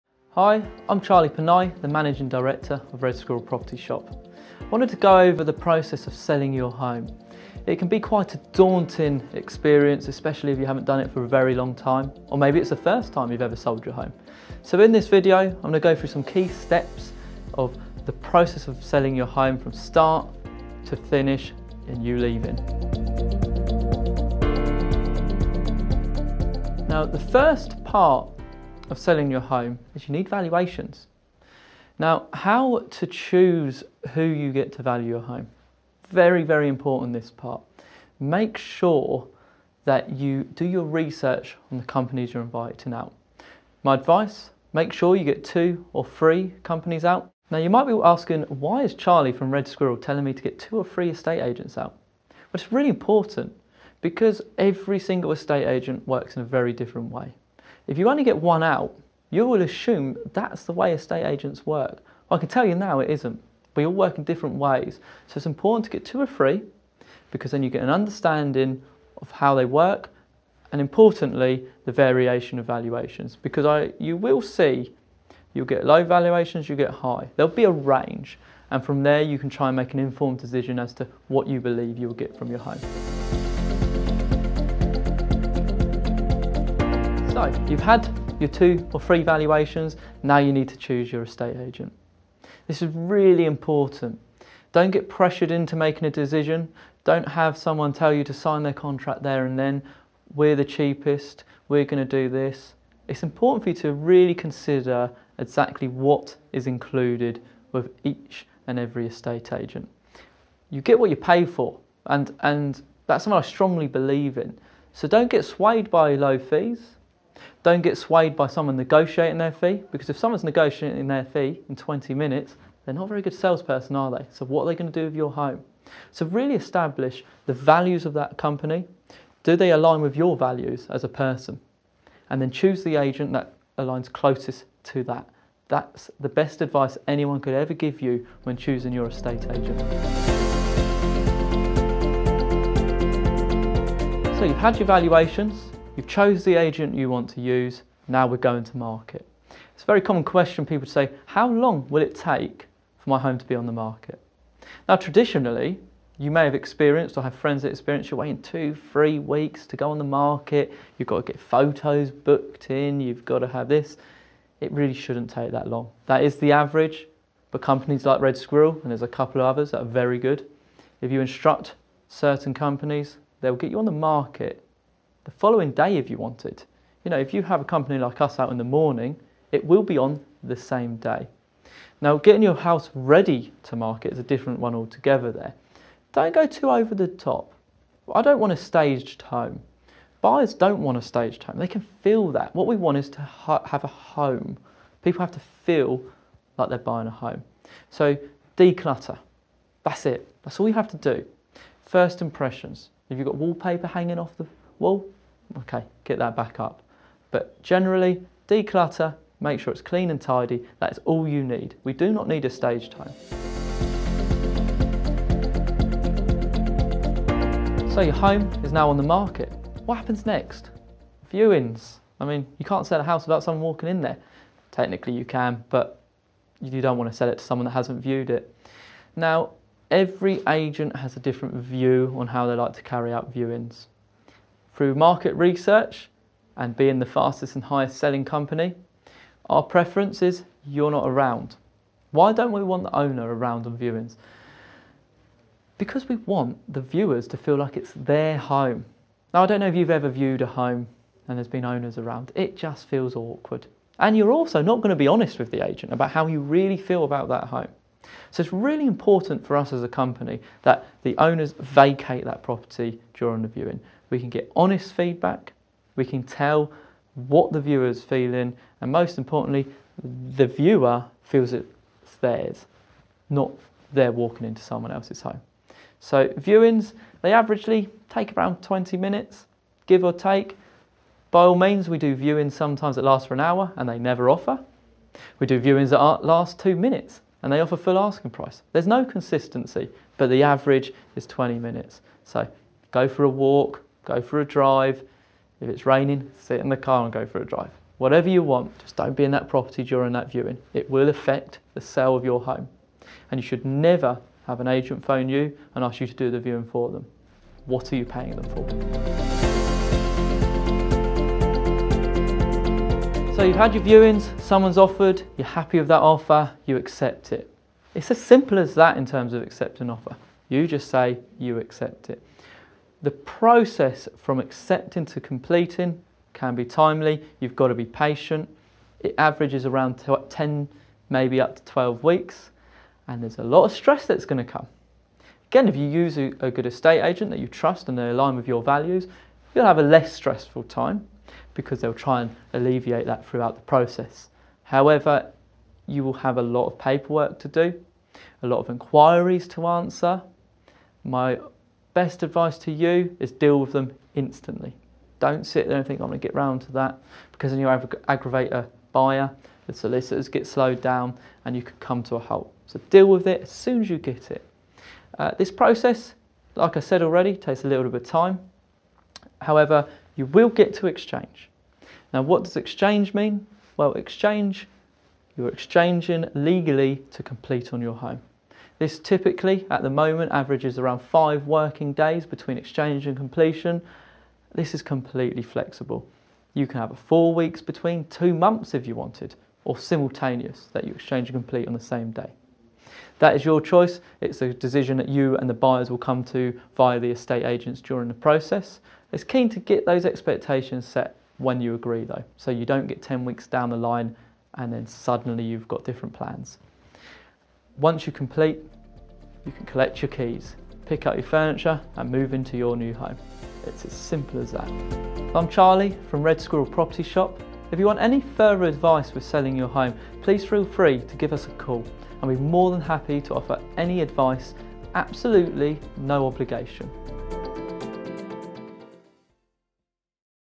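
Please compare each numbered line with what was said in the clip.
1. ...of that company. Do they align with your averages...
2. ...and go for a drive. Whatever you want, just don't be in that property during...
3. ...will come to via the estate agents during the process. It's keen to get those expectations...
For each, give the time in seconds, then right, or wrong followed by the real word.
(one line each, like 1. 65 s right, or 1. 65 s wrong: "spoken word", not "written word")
1. 128 s wrong: "values", not "averages"
2. 297 s right
3. 395 s right.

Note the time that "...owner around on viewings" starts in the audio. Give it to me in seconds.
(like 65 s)
242 s.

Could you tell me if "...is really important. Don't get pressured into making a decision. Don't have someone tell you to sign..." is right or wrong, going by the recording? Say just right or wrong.
right.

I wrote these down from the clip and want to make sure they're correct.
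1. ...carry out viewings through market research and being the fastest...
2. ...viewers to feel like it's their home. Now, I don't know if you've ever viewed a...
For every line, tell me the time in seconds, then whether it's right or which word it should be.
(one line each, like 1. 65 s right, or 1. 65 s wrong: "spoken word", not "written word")
1. 232 s right
2. 246 s right.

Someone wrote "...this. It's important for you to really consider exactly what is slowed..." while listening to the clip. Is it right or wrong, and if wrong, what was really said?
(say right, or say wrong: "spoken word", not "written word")
wrong: "included", not "slowed".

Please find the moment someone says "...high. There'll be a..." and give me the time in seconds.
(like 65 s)
76 s.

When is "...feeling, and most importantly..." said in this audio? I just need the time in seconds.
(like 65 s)
268 s.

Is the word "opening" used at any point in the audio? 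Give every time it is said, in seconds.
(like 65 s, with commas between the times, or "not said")
not said.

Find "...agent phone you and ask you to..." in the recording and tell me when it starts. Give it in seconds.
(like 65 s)
304 s.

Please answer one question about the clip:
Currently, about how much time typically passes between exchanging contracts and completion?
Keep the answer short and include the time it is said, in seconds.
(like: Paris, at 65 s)
5 working days, at 381 s.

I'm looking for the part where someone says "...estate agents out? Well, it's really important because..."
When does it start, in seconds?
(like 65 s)
51 s.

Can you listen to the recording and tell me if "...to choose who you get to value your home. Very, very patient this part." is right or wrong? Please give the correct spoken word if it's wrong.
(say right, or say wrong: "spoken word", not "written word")
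wrong: "important", not "patient".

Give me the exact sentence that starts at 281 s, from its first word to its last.
By all means, we do viewings sometimes that last for an hour and they never offer.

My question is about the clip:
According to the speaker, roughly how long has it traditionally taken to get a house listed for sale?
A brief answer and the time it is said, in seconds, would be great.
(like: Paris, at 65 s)
2 or 3 weeks, at 158 s.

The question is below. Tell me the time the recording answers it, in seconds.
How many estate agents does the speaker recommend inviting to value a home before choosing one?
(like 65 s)
45 s.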